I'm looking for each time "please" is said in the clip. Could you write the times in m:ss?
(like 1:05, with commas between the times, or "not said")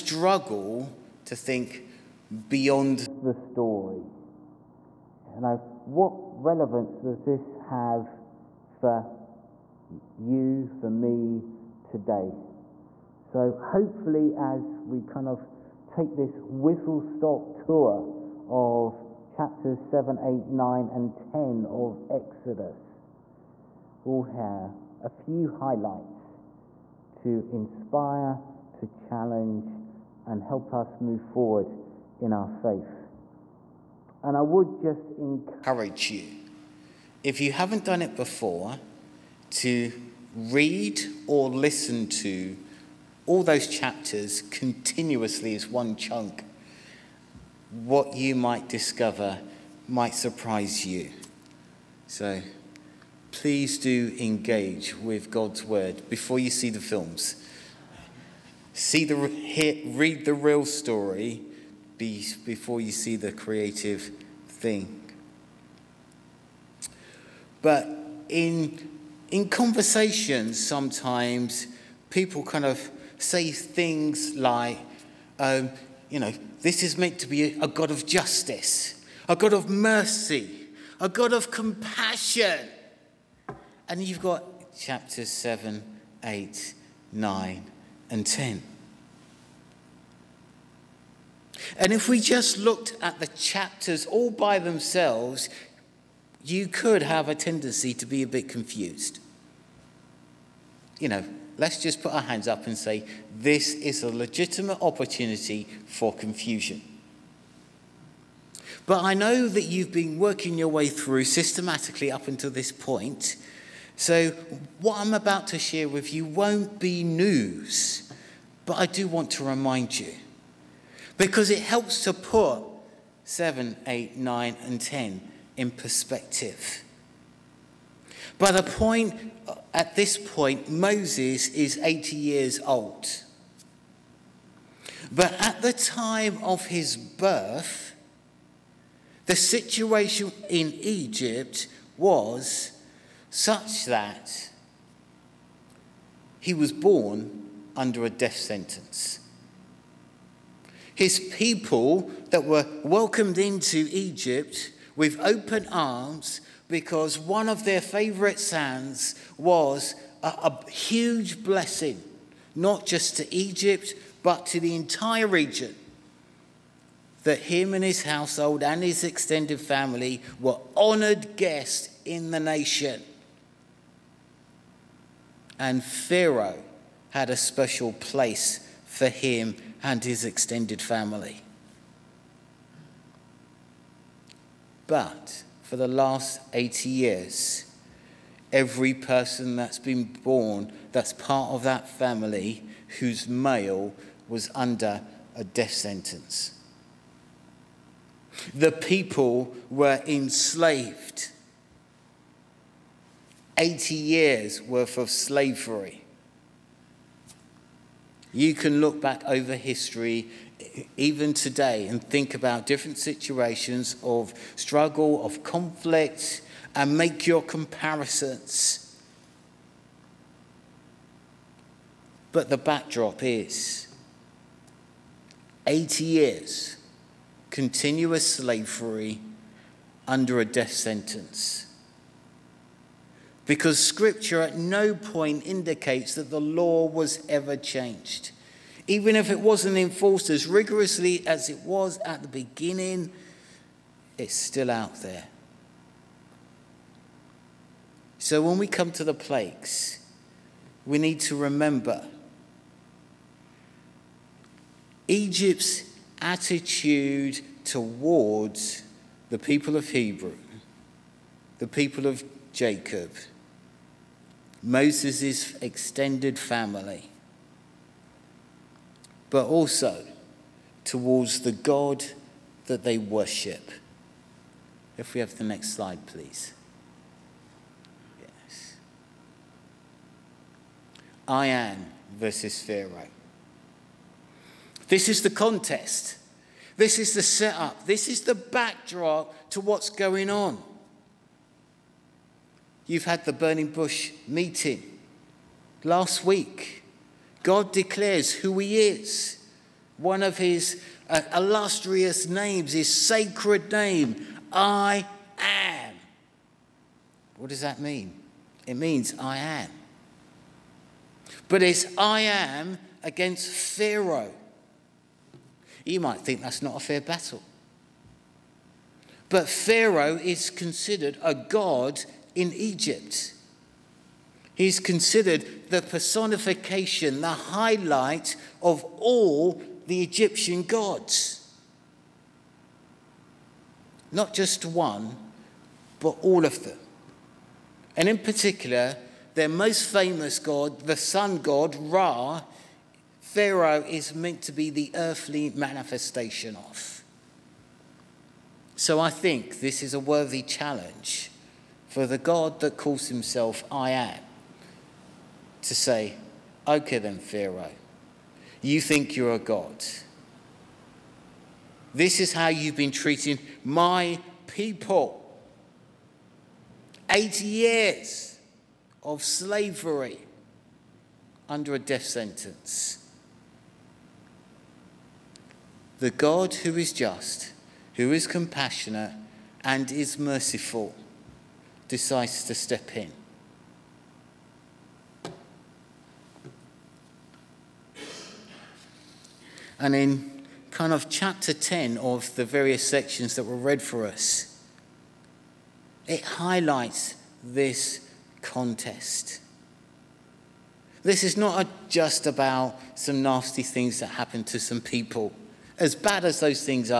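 0:53, 4:36.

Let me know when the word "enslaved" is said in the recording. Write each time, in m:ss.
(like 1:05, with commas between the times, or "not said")
3:20.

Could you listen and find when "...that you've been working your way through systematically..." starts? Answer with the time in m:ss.
1:49.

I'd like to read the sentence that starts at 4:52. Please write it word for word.
You've had the burning bush meeting last week.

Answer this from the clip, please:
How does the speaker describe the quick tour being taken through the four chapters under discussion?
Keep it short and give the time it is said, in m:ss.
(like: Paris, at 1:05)
whistle-stop tour, at 0:16.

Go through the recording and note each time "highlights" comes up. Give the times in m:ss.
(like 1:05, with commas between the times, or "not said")
0:25, 5:27, 6:36.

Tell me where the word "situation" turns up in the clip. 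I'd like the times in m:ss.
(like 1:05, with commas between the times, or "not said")
2:19, 3:32.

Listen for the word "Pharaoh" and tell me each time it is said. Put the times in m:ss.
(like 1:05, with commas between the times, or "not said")
2:55, 4:42, 5:13, 5:19, 5:43, 5:57.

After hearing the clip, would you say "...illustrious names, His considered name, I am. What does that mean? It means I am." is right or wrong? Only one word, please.
wrong.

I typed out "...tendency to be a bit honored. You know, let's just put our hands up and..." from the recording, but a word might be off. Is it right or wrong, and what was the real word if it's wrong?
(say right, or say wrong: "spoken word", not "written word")
wrong: "confused", not "honored".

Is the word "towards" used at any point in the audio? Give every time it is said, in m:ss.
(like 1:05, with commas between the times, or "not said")
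4:17, 4:30.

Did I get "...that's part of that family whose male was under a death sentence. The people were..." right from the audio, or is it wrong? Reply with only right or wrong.
right.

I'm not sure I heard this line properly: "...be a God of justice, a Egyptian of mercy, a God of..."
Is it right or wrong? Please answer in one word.
wrong.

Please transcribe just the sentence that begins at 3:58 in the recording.
Even if it wasn't enforced as rigorously as it was at the beginning, it's still out there.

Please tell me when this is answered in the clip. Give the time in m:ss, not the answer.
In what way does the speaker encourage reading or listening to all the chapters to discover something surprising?
0:45.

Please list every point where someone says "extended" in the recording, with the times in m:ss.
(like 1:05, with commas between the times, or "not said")
2:49, 3:00, 4:25.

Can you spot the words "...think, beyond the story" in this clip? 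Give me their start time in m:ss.
0:01.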